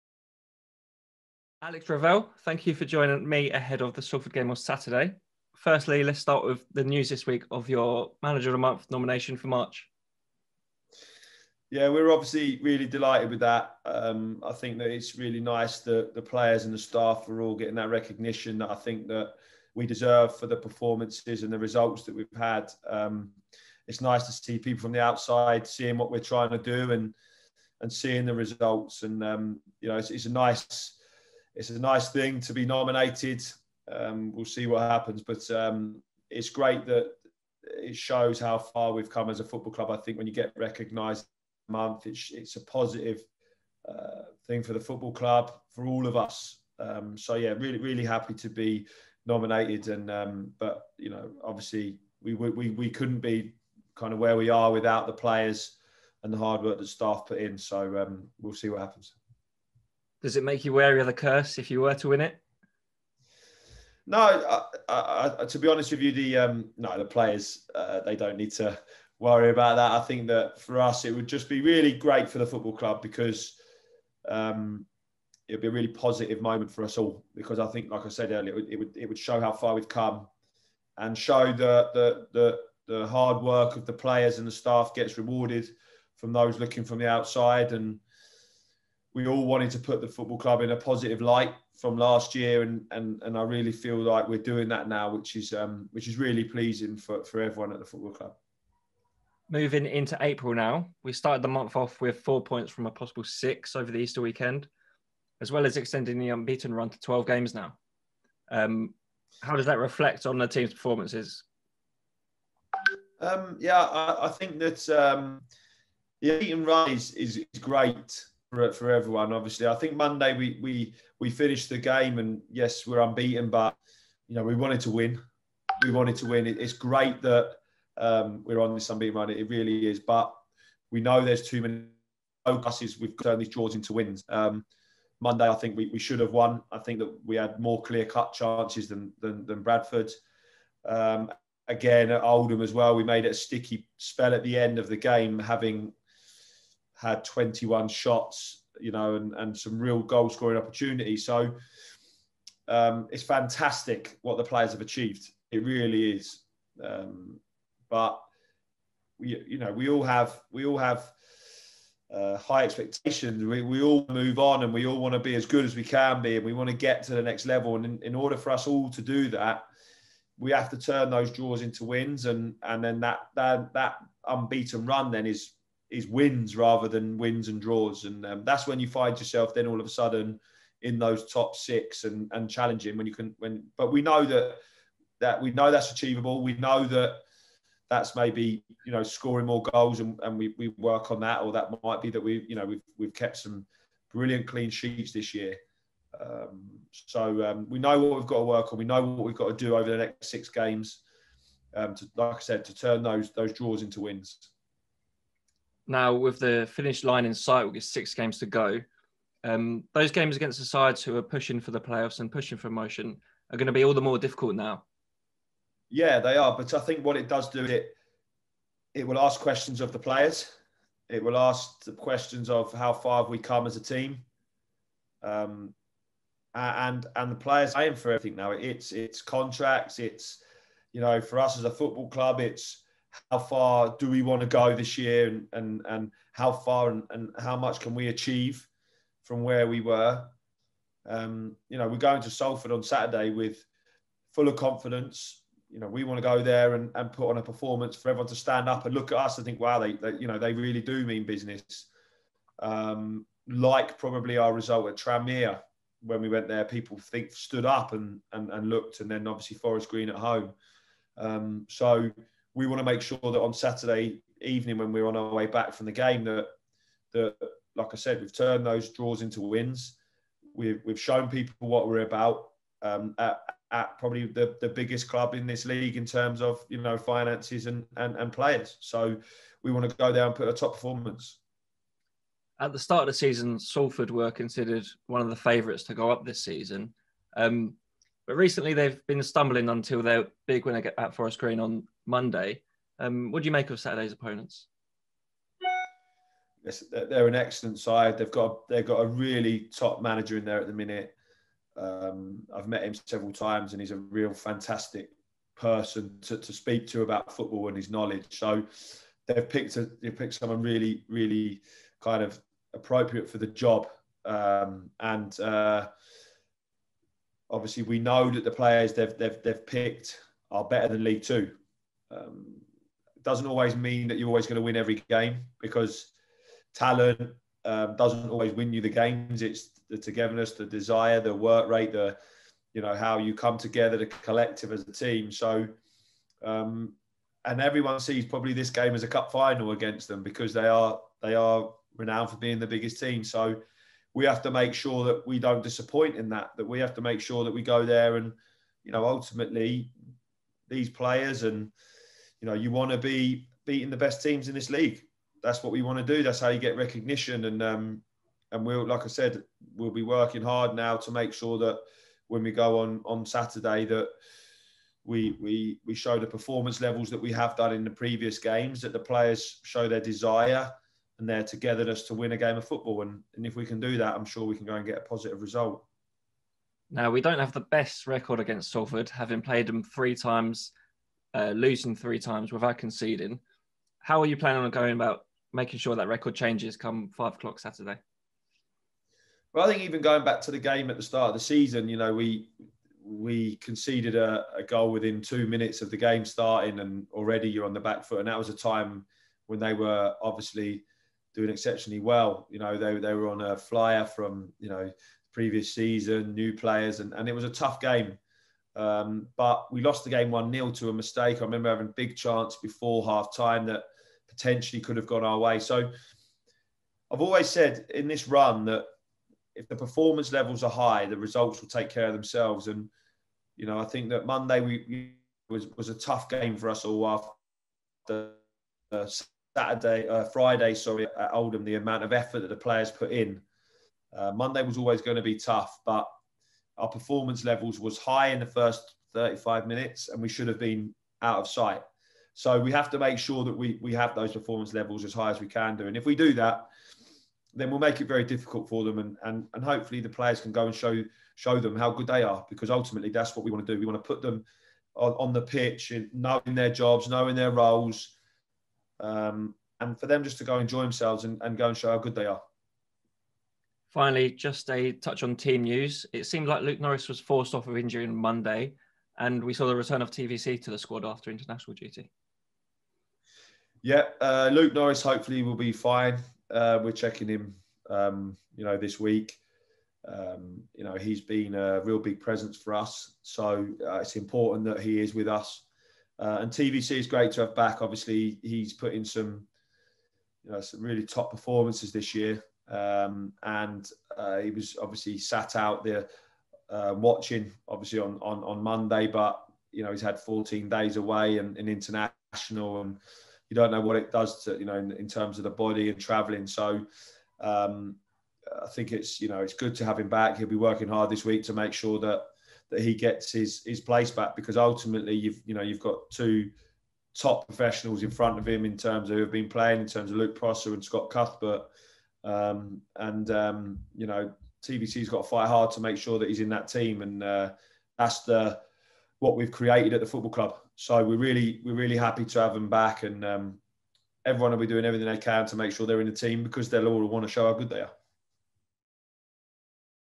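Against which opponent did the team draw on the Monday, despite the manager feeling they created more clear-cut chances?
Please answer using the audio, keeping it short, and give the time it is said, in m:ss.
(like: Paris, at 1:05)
Bradford, at 2:19.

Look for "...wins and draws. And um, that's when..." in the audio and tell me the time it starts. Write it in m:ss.
2:57.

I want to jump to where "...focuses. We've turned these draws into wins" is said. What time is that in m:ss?
2:12.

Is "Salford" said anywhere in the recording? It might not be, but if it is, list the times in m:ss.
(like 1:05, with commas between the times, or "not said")
0:04, 4:02, 4:43, 6:18.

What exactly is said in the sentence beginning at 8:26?
So um, I think it's you know it's good to have him back.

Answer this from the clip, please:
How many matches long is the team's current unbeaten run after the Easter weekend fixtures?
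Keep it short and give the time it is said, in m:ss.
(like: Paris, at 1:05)
12, at 1:46.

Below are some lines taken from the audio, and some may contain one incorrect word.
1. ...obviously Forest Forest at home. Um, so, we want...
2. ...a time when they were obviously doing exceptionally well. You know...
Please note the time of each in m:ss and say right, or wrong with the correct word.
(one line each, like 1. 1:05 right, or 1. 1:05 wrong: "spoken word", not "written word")
1. 4:19 wrong: "Green", not "Forest"
2. 6:38 right.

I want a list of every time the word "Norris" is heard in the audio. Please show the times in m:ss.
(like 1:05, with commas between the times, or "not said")
7:46, 7:54.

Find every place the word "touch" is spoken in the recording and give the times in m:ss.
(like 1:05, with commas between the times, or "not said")
7:44.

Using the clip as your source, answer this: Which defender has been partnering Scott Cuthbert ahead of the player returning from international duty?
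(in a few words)
Luke Prosser.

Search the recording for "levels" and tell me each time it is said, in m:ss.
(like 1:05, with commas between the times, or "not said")
2:47, 6:06, 7:00, 7:17, 7:24.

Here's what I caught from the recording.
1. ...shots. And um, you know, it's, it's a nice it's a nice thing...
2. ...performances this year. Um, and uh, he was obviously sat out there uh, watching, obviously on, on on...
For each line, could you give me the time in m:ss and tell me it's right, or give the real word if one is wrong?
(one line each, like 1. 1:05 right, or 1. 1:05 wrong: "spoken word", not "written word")
1. 0:28 wrong: "results", not "shots"
2. 8:11 right.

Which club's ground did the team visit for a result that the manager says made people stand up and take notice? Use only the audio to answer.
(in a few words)
Tranmere.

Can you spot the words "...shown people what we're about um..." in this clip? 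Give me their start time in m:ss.
4:30.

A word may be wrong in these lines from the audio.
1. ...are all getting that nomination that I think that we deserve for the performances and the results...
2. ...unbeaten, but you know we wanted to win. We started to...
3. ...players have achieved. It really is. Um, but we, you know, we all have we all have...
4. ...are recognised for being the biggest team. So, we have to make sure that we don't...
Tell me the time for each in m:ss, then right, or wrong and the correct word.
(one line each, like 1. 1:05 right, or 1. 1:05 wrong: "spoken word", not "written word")
1. 0:17 wrong: "recognition", not "nomination"
2. 2:03 wrong: "wanted", not "started"
3. 2:34 right
4. 5:41 wrong: "renowned", not "recognised".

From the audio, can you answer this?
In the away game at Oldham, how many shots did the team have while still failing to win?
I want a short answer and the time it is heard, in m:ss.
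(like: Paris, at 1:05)
21, at 2:27.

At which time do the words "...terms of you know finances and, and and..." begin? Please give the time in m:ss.
4:36.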